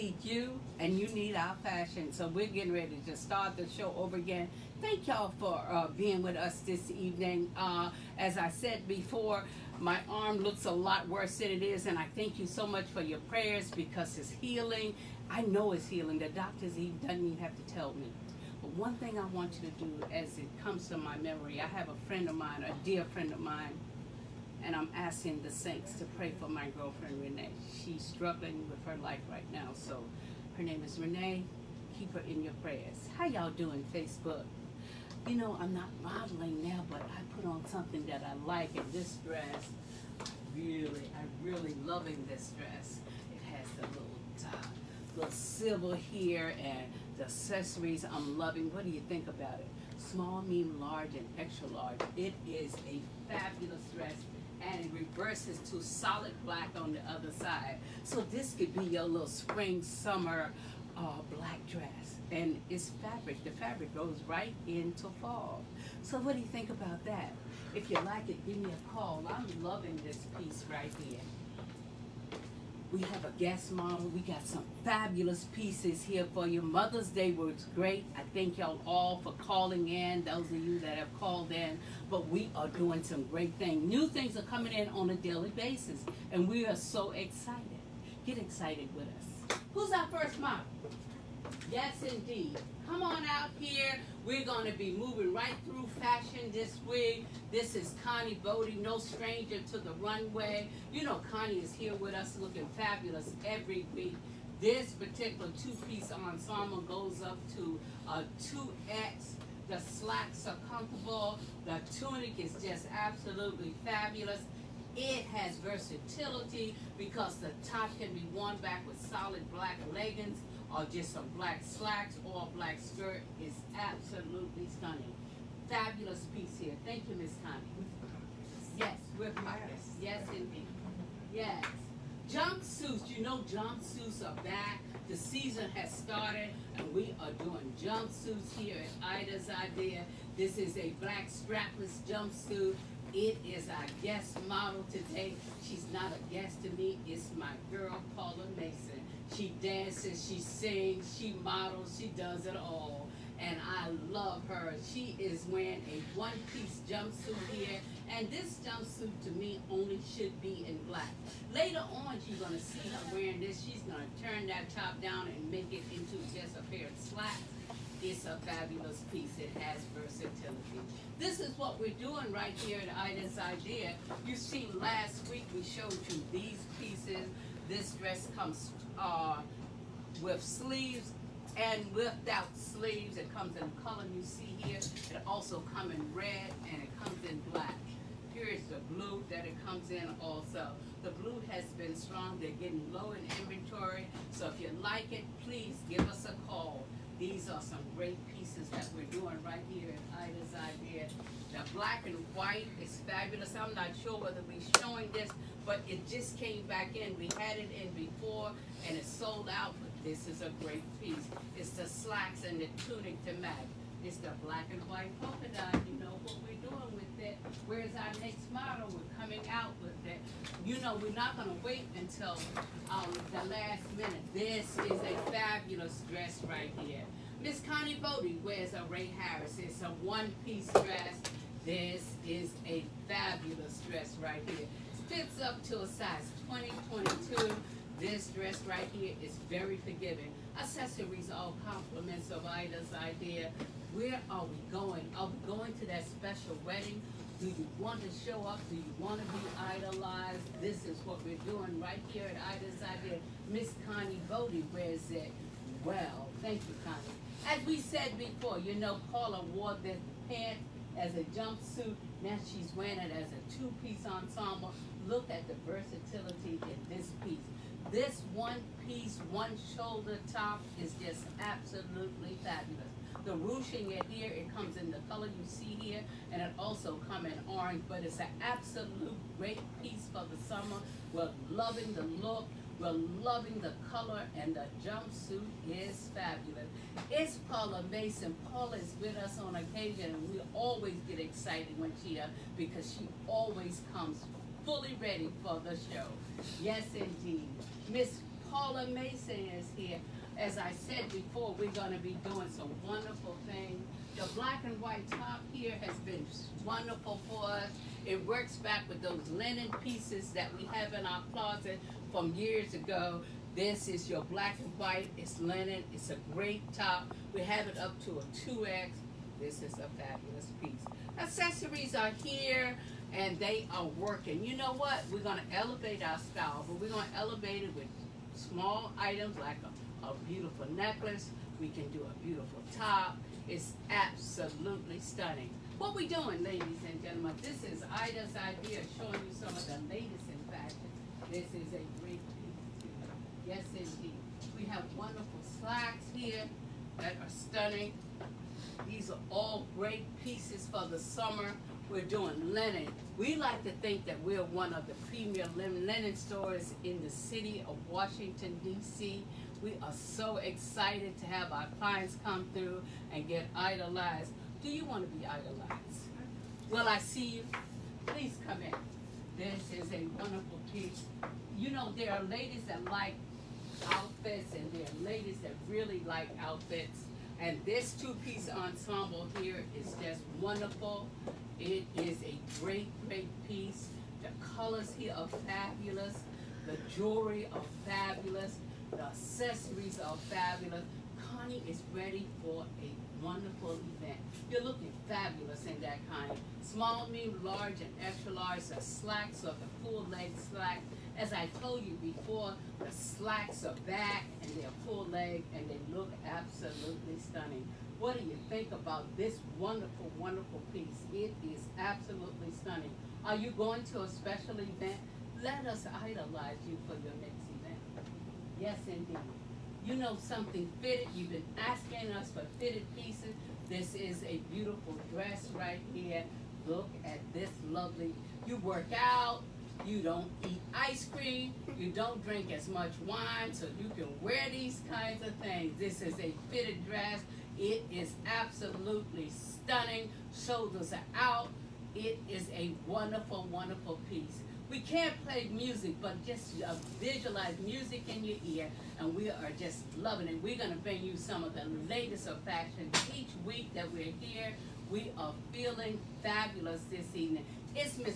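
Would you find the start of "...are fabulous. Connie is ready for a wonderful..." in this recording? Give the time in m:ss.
6:29.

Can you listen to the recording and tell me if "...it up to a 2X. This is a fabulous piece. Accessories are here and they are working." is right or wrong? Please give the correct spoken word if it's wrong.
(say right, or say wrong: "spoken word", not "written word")
right.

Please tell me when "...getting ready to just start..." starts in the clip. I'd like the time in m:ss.
0:02.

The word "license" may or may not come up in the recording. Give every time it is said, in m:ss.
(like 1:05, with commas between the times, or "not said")
not said.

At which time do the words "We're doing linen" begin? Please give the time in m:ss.
5:51.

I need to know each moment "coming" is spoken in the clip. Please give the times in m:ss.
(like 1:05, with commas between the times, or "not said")
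1:24, 3:39.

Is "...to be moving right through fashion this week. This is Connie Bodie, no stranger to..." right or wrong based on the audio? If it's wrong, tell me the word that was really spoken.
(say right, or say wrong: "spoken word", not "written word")
right.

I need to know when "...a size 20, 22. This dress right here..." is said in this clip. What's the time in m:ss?
3:55.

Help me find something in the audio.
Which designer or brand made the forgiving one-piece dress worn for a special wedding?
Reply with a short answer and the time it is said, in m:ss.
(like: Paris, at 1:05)
Ray Harris, at 3:48.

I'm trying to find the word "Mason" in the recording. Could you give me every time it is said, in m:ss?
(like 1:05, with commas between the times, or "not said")
2:28, 4:47, 4:58.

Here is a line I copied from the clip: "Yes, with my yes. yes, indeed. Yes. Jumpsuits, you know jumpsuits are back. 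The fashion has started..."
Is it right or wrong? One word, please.
wrong.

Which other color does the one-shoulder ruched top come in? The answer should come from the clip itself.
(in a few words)
Orange.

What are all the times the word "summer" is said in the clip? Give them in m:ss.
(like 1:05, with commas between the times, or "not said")
0:59, 4:40, 5:50.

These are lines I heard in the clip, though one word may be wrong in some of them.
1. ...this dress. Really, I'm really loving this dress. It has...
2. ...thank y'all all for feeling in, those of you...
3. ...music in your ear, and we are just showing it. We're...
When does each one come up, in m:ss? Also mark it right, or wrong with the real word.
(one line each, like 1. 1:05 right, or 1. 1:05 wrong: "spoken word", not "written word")
1. 0:38 right
2. 1:18 wrong: "calling", not "feeling"
3. 7:27 wrong: "loving", not "showing".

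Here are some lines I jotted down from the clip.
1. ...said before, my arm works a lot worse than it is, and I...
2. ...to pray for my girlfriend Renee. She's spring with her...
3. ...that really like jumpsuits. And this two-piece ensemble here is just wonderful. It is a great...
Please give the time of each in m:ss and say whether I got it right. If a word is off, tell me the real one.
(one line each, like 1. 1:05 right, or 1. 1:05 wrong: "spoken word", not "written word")
1. 0:08 wrong: "looks", not "works"
2. 0:25 wrong: "struggling", not "spring"
3. 6:15 wrong: "outfits", not "jumpsuits".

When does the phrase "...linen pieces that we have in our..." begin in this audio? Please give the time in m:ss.
5:09.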